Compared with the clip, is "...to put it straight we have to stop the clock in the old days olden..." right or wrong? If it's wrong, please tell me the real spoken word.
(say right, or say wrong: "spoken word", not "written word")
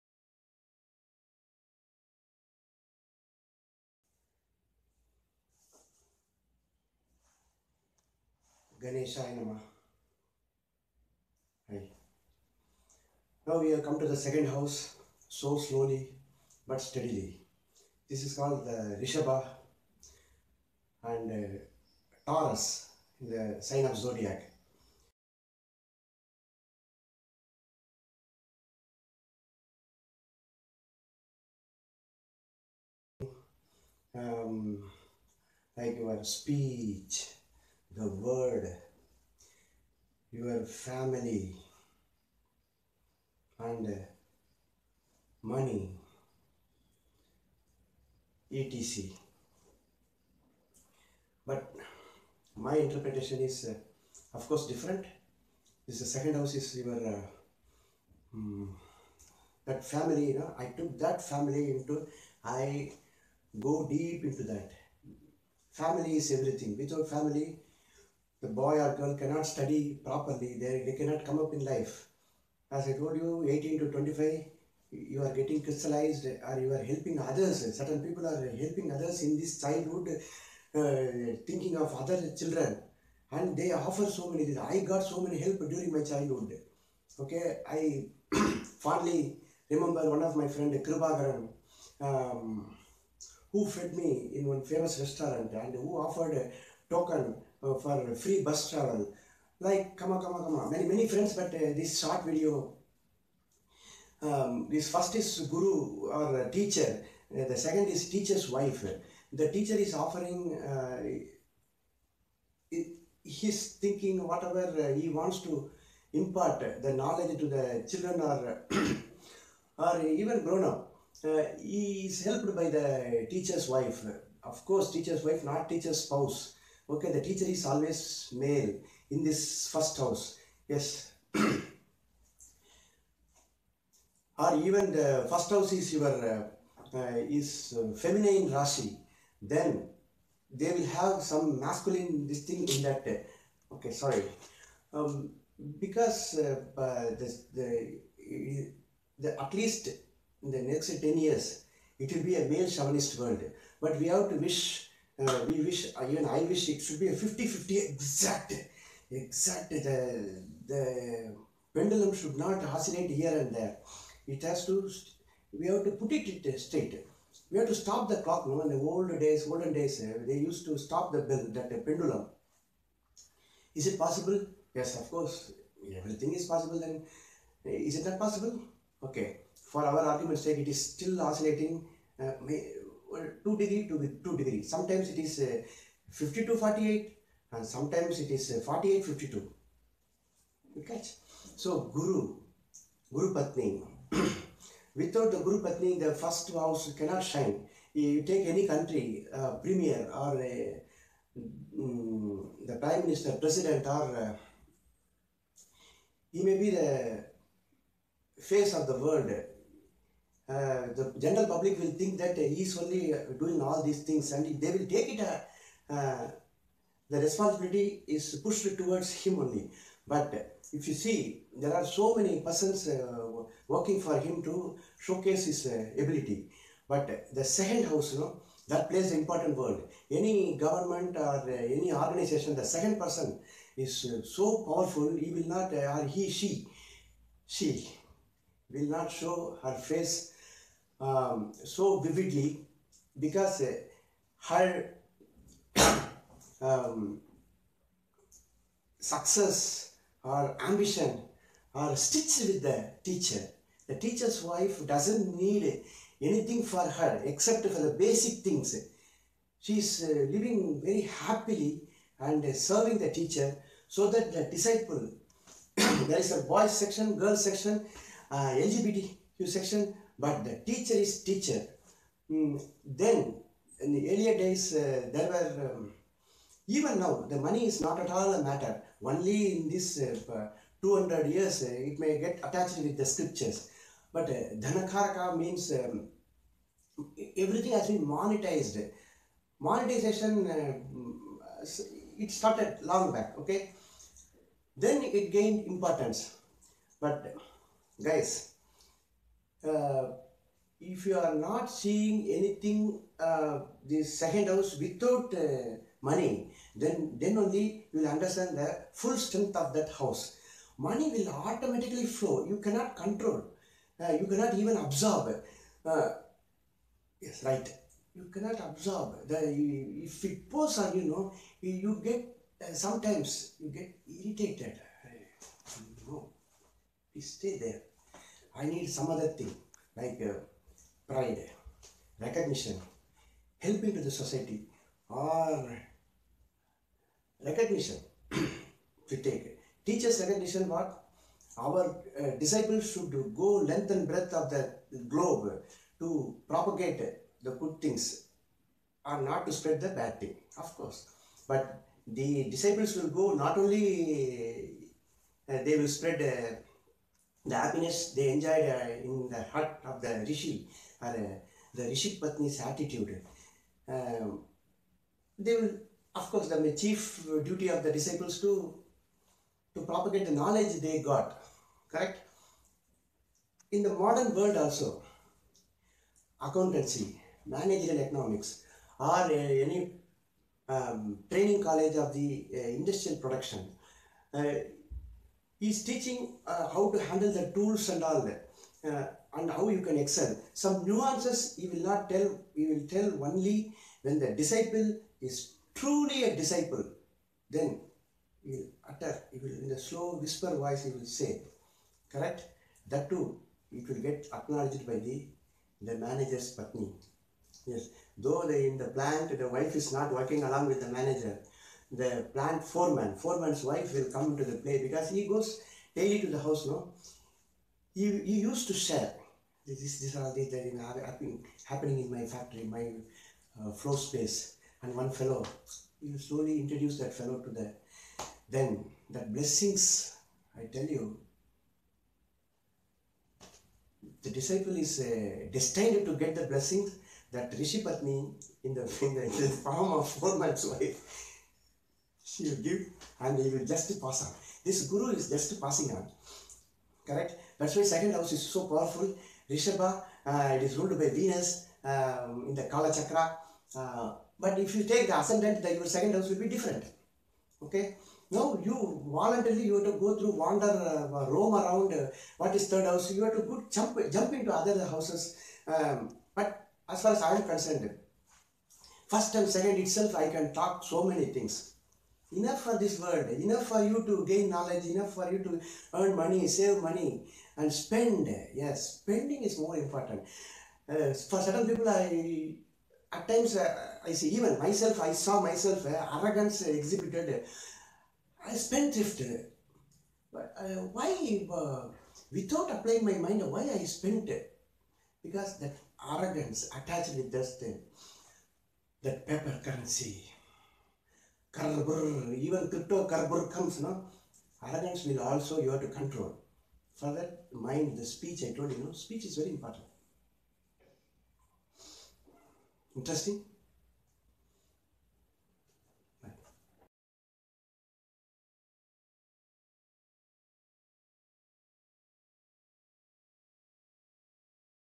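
right.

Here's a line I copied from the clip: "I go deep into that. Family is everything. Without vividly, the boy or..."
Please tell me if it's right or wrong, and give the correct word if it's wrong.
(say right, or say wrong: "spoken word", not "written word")
wrong: "family", not "vividly".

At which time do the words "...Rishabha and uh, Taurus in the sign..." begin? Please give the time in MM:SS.
00:18.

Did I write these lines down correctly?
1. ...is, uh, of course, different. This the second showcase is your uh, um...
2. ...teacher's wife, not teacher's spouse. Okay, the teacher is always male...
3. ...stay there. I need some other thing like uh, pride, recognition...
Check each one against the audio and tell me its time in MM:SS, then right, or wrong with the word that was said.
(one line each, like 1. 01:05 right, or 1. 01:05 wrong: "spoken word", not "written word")
1. 00:53 wrong: "house", not "showcase"
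2. 02:04 right
3. 05:27 right.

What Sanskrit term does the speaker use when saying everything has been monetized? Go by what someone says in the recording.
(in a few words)
Dhanakaraka.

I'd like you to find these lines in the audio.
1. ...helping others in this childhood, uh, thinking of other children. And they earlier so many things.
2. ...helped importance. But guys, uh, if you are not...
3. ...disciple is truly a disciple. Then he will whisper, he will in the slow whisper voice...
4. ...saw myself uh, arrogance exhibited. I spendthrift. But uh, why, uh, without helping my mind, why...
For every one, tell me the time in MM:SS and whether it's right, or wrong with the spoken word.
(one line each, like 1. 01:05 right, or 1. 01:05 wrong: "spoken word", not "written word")
1. 01:18 wrong: "offer", not "earlier"
2. 04:55 wrong: "gained", not "helped"
3. 06:34 wrong: "utter", not "whisper"
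4. 08:05 wrong: "applying", not "helping".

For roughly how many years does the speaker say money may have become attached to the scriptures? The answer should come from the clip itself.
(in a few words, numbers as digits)
200 years.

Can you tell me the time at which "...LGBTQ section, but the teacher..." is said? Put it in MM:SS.
04:28.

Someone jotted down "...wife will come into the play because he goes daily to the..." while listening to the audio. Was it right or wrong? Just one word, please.
right.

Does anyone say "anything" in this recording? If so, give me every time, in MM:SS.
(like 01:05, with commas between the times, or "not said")
04:16, 05:02.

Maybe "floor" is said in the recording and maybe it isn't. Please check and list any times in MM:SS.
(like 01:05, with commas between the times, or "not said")
07:03.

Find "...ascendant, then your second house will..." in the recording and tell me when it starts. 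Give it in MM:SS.
07:35.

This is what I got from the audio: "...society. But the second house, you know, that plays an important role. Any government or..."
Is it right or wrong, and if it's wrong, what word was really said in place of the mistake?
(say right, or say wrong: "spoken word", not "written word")
wrong: "ability", not "society".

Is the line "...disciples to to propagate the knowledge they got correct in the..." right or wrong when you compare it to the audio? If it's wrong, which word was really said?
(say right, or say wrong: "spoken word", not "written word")
right.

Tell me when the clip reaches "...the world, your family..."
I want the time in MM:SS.
00:37.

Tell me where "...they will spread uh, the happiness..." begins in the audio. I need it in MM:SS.
05:55.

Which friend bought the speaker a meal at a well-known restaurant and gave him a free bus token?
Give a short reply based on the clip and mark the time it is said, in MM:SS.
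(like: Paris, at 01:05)
Kribagaran, at 01:30.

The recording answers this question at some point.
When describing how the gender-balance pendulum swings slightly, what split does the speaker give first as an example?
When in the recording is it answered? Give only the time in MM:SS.
03:06.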